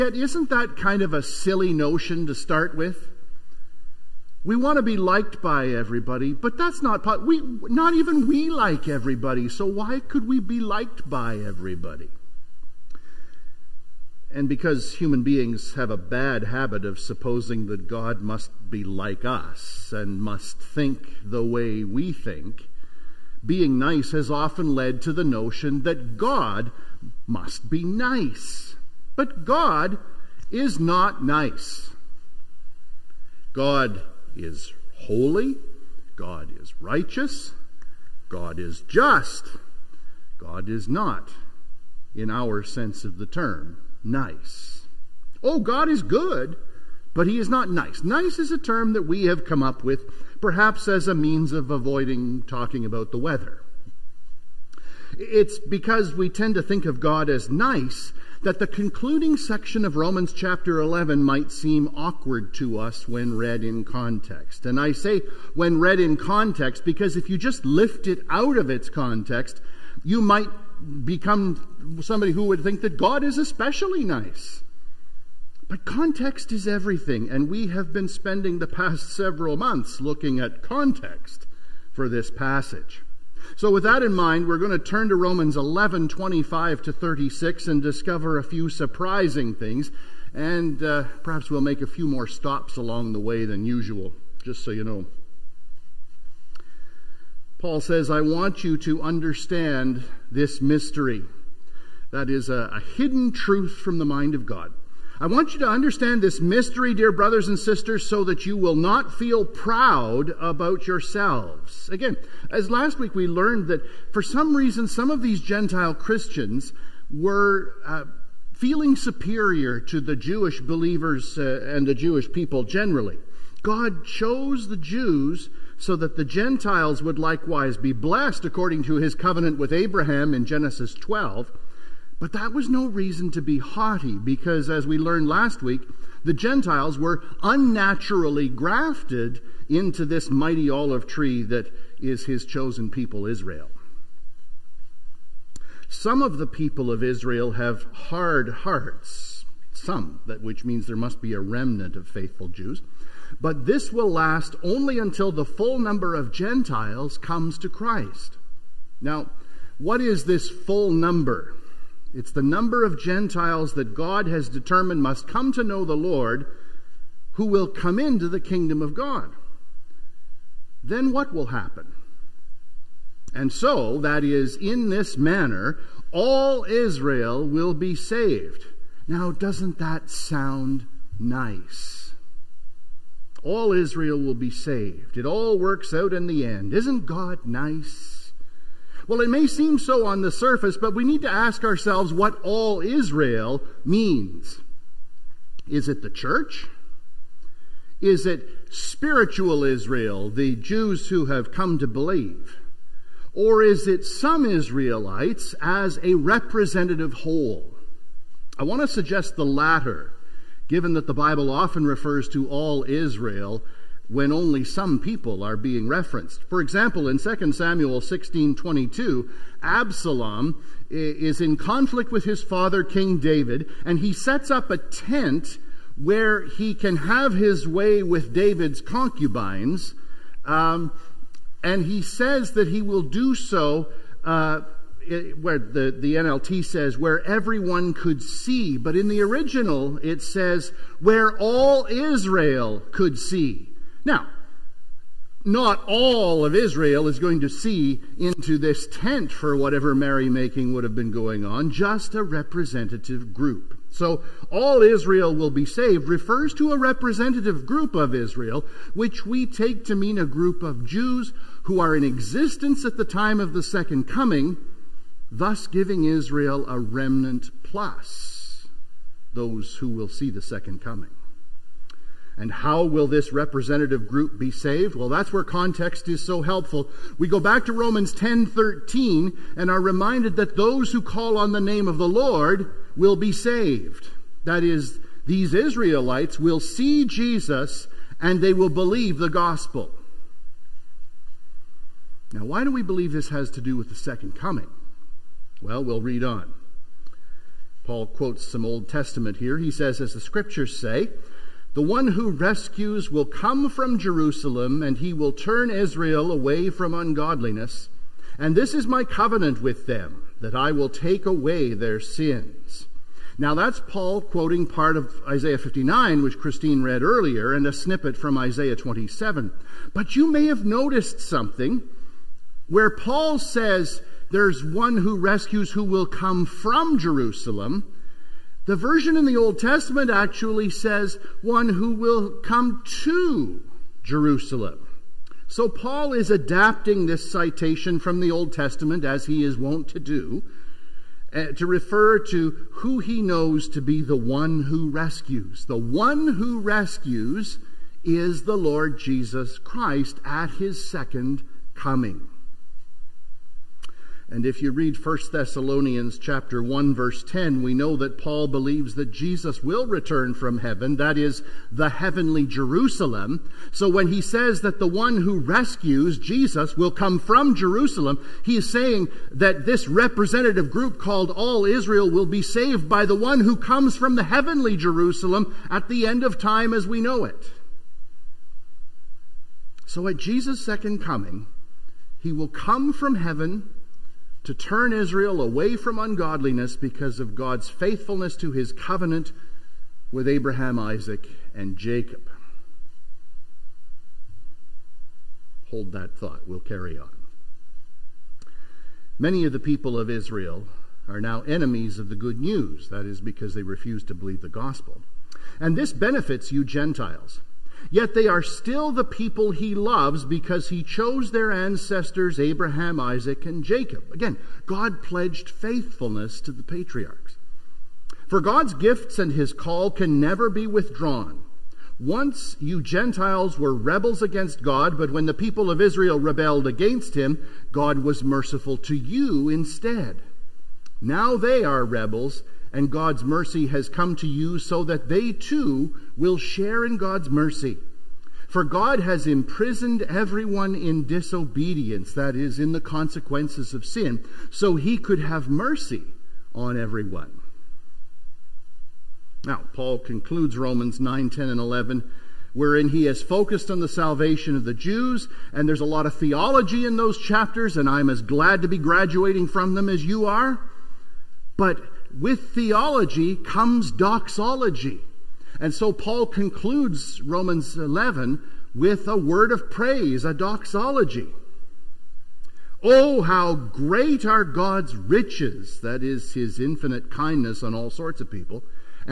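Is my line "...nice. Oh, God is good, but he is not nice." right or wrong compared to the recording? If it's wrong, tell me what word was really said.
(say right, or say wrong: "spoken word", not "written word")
right.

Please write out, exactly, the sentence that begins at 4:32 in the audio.
And how will this representative group be saved?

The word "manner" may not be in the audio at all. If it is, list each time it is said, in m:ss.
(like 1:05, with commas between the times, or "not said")
2:55.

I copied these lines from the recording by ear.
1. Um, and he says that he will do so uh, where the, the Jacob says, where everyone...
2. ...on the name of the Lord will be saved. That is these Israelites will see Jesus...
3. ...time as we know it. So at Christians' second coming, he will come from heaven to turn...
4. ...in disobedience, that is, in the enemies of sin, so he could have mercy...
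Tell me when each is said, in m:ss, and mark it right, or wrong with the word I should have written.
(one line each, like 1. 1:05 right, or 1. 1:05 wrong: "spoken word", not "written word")
1. 3:50 wrong: "NLT", not "Jacob"
2. 4:41 right
3. 6:16 wrong: "Jesus", not "Christians"
4. 7:20 wrong: "consequences", not "enemies".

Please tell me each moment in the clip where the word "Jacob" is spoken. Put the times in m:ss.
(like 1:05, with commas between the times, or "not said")
6:31, 6:53.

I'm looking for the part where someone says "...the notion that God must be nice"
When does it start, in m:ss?
0:25.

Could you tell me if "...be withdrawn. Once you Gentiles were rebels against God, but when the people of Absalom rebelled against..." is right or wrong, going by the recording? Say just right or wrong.
wrong.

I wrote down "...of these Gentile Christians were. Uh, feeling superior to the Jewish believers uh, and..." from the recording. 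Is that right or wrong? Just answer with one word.
right.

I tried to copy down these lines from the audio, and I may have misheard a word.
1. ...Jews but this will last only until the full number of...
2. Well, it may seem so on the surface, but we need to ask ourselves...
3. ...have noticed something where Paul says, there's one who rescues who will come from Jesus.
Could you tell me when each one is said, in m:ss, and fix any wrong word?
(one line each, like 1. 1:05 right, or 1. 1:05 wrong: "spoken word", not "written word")
1. 2:32 right
2. 3:09 right
3. 5:20 wrong: "Jerusalem", not "Jesus".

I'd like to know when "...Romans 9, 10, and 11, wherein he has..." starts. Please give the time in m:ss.
7:30.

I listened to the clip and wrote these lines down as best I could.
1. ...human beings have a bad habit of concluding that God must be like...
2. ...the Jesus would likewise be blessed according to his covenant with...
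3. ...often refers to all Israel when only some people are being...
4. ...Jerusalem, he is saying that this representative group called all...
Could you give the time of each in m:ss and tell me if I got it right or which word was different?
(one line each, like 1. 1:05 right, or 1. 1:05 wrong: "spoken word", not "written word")
1. 0:14 wrong: "supposing", not "concluding"
2. 2:06 wrong: "Gentiles", not "Jesus"
3. 3:31 right
4. 6:07 right.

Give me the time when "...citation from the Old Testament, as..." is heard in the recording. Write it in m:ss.
5:37.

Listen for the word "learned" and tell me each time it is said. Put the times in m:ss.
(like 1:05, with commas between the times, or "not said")
1:53, 2:14.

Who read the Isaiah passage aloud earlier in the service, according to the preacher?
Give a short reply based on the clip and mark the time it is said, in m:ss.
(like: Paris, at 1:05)
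Christine, at 5:16.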